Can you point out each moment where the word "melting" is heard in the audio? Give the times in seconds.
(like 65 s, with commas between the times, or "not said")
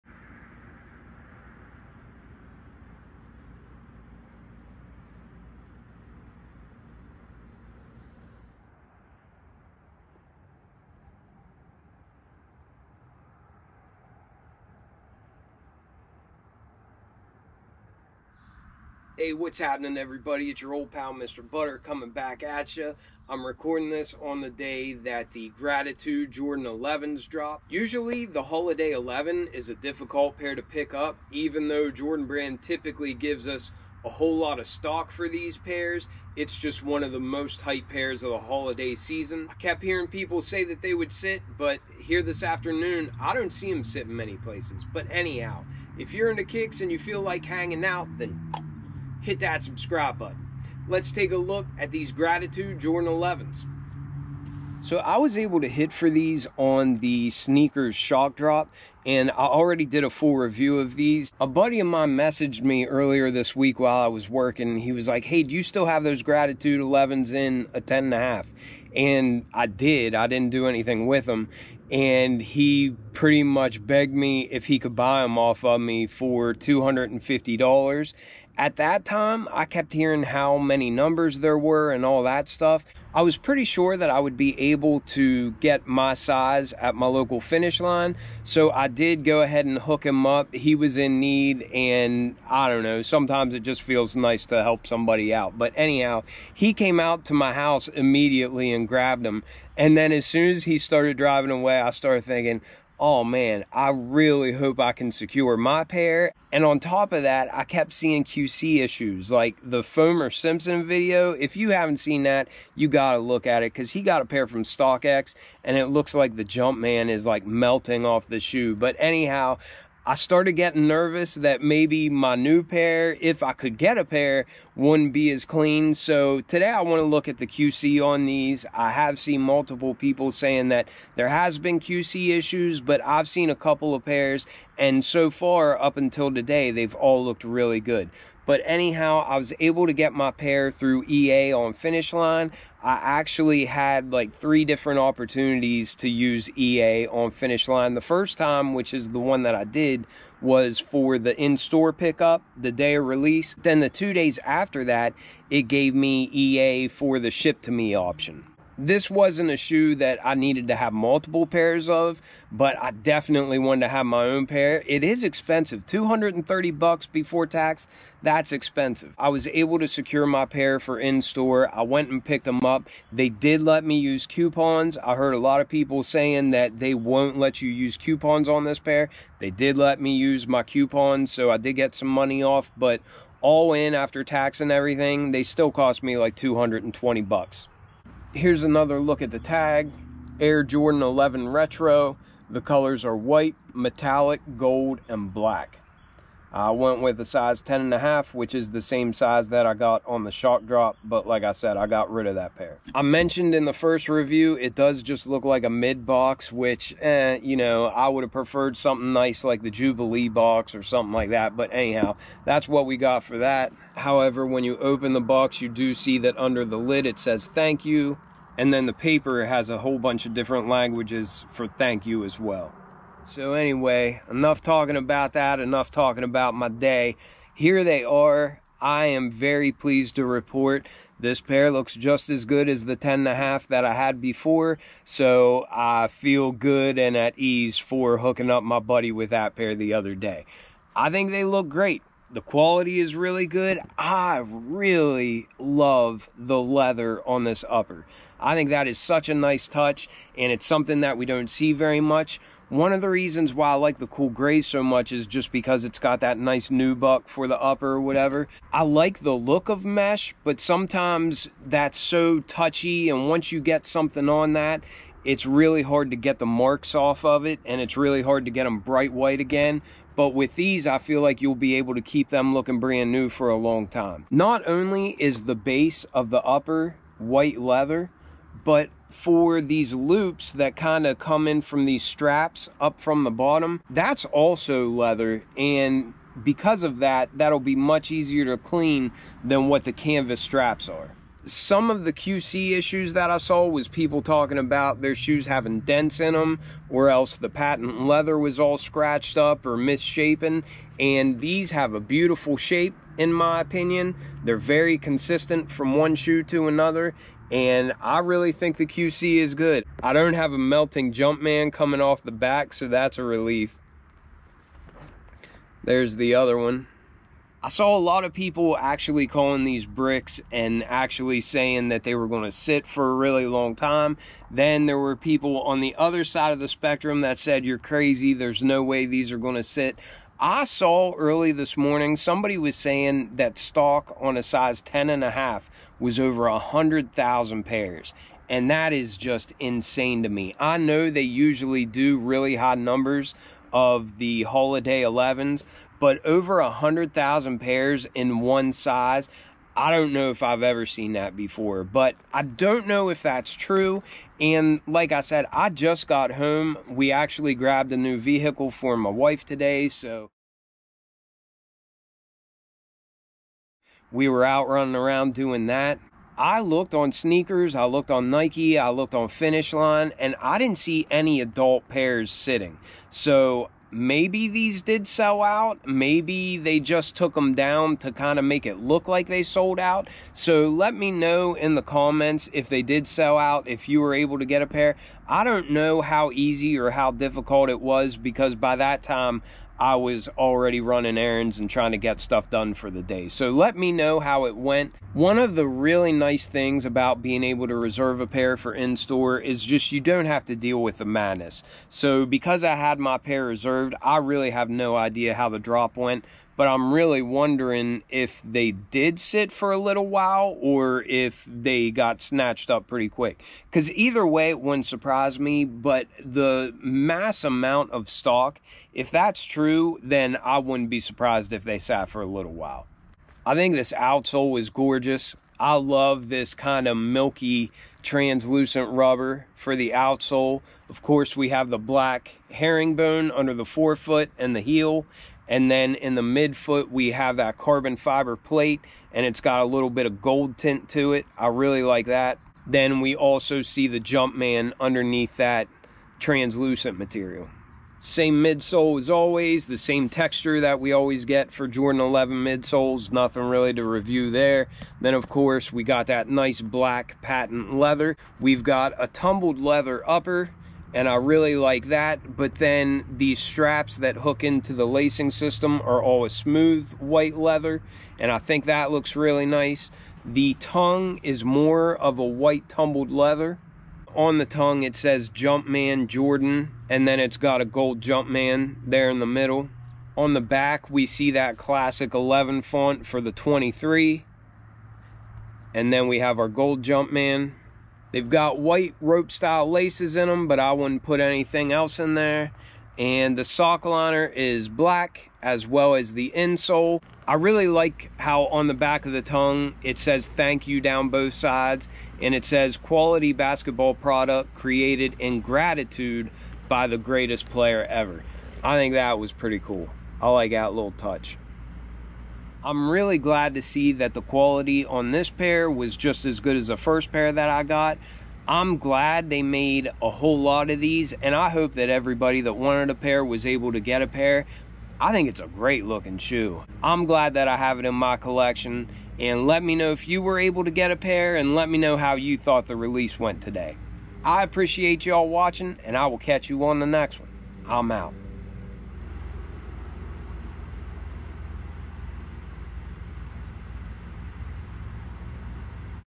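117 s, 310 s.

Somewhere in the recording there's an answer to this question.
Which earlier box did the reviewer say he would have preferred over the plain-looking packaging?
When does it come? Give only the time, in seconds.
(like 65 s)
209 s.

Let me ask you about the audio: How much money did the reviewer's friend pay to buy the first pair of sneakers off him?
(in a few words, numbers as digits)
$250.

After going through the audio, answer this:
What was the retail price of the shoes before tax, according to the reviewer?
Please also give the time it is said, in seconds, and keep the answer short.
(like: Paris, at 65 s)
$230, at 165 s.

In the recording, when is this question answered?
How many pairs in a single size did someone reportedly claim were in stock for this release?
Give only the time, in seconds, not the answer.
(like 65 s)
336 s.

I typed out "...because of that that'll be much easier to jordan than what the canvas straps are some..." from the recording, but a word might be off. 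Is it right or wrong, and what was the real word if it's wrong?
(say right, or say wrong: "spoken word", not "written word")
wrong: "clean", not "jordan".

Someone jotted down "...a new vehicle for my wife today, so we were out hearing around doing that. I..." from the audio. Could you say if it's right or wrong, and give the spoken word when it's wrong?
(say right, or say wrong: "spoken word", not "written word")
wrong: "running", not "hearing".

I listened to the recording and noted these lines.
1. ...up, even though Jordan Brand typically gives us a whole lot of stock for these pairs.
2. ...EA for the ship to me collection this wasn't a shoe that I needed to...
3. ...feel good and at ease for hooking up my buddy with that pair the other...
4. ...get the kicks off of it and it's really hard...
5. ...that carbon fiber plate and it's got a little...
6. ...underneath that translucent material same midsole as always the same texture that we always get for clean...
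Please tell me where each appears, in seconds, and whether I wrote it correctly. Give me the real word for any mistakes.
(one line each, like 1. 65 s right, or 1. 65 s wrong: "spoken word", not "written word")
1. 30 s right
2. 156 s wrong: "option", not "collection"
3. 236 s right
4. 266 s wrong: "marks", not "kicks"
5. 437 s right
6. 444 s wrong: "jordan", not "clean".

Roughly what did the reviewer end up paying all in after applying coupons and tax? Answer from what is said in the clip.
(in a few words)
$220.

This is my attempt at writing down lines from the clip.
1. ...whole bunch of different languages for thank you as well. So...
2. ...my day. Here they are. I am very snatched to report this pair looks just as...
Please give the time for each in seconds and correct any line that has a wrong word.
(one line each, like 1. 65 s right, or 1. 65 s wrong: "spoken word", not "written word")
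1. 219 s right
2. 226 s wrong: "pleased", not "snatched".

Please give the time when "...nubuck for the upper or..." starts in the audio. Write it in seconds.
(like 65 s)
256 s.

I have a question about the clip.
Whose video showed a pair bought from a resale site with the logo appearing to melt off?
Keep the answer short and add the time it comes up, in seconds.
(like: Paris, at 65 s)
Foamer Simpson, at 109 s.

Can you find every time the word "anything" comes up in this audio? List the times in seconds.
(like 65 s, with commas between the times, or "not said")
70 s, 491 s.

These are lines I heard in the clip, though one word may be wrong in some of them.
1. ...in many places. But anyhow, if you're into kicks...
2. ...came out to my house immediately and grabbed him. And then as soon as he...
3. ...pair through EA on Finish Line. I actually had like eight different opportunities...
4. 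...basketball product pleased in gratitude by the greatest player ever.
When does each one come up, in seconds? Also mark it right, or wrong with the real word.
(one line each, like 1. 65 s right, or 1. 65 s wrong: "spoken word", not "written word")
1. 44 s right
2. 96 s right
3. 140 s wrong: "three", not "eight"
4. 503 s wrong: "created", not "pleased".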